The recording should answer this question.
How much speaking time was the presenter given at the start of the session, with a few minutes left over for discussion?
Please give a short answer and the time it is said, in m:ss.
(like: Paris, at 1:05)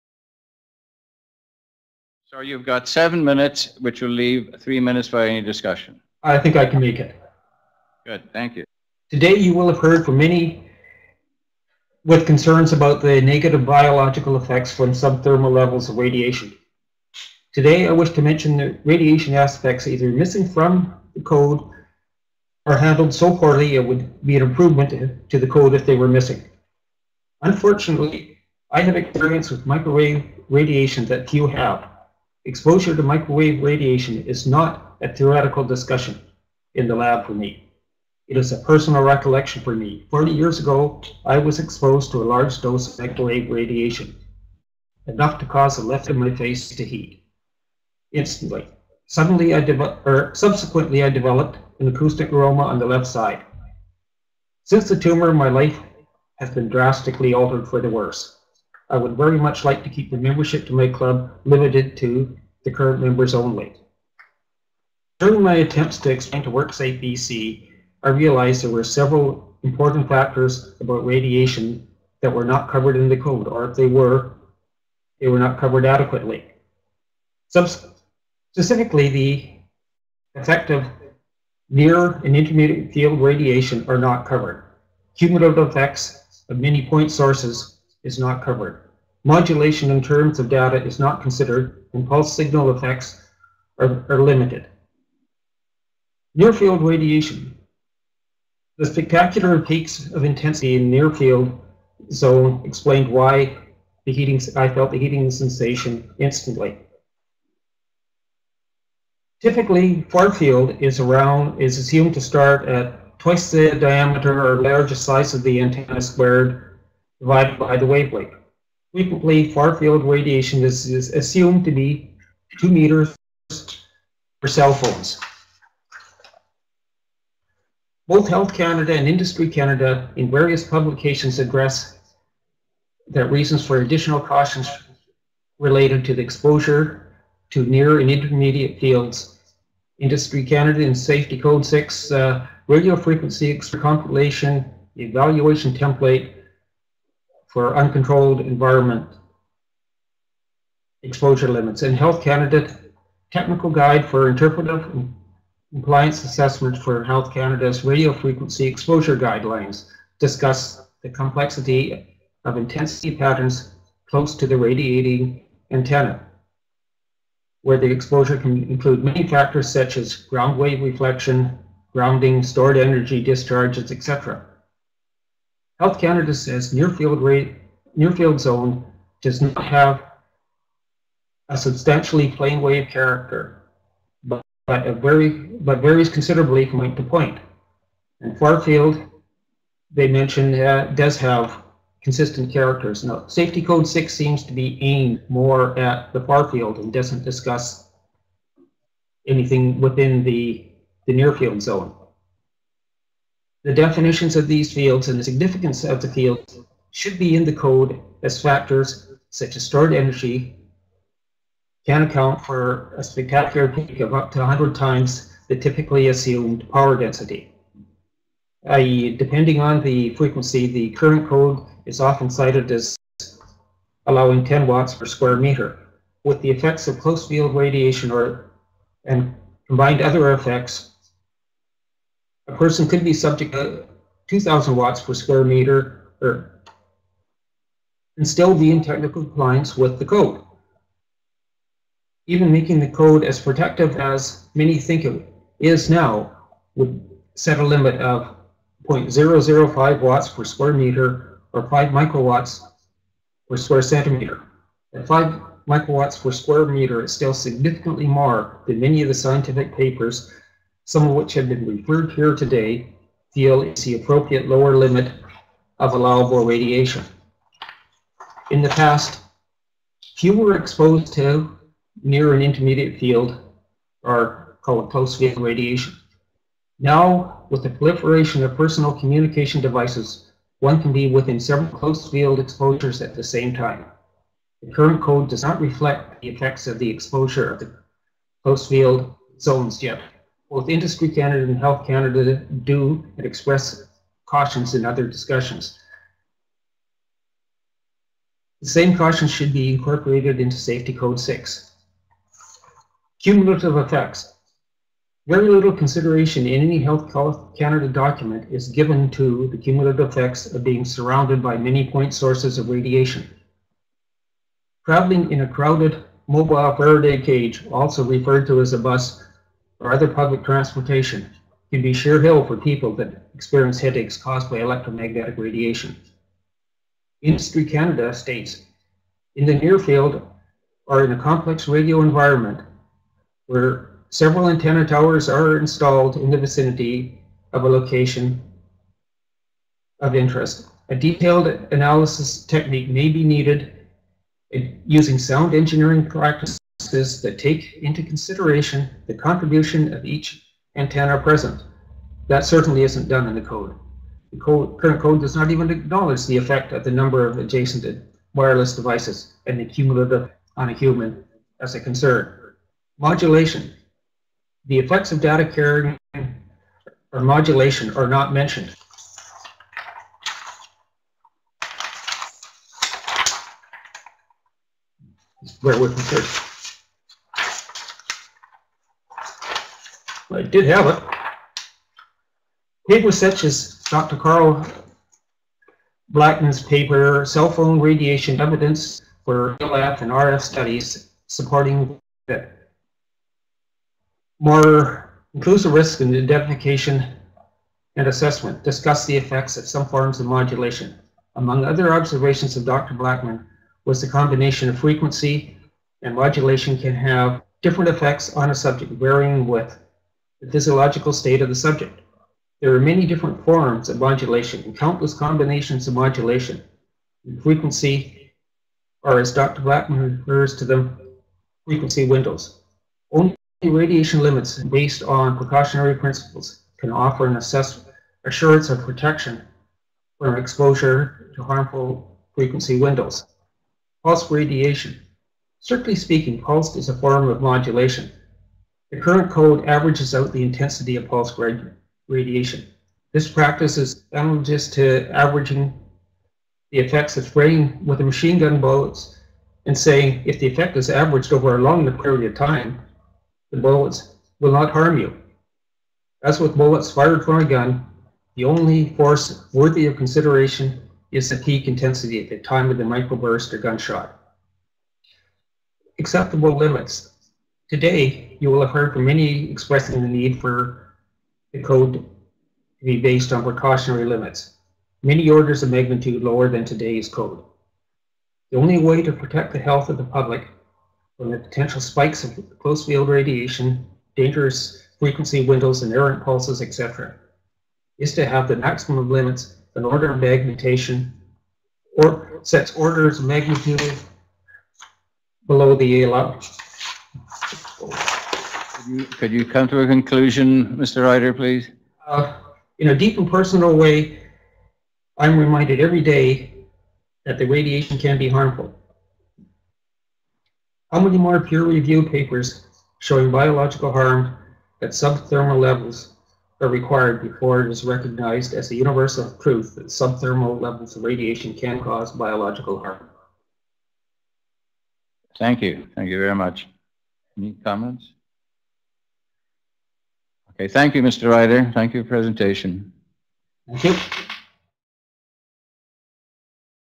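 7 minutes, at 0:02.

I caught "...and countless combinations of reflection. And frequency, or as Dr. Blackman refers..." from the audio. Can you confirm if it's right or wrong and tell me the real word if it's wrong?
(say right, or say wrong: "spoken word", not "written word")
wrong: "modulation", not "reflection".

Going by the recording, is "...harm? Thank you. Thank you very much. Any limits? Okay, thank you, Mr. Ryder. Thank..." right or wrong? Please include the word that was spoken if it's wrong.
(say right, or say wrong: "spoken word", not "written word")
wrong: "comments", not "limits".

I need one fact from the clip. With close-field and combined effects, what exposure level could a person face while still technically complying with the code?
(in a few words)
2,000 watts per square meter.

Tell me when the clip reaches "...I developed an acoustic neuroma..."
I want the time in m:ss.
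0:51.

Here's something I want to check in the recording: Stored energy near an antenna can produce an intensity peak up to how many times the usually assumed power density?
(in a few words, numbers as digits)
100 times.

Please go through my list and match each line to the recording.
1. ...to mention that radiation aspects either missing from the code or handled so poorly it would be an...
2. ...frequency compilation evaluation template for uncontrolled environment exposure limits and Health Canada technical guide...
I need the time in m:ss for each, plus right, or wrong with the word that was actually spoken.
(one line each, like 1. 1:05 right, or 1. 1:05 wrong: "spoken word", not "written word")
1. 0:18 right
2. 2:22 right.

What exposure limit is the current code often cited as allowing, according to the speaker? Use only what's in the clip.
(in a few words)
10 watts per square meter.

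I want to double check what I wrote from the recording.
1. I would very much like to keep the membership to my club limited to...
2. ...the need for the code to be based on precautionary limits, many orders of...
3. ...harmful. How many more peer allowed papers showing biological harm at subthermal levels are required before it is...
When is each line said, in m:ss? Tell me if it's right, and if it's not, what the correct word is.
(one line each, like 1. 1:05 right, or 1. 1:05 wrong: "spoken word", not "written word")
1. 0:58 right
2. 7:50 right
3. 8:28 wrong: "reviewed", not "allowed".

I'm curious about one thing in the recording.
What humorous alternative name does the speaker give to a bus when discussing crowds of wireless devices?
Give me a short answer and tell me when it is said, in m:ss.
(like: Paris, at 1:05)
mobile Faraday cage, at 5:16.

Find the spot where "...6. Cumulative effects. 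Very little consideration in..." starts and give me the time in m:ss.
5:01.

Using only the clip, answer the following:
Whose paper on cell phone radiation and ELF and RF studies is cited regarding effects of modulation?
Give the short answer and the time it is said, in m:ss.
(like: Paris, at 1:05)
Carl Blackman, at 6:24.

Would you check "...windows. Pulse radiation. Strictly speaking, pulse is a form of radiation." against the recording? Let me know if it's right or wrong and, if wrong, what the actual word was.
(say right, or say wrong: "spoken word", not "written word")
wrong: "modulation", not "radiation".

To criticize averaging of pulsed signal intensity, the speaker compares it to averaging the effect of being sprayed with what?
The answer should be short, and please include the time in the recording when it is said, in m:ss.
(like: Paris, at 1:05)
machine gun bullets, at 7:28.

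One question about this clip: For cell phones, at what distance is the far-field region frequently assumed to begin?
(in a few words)
2 meters.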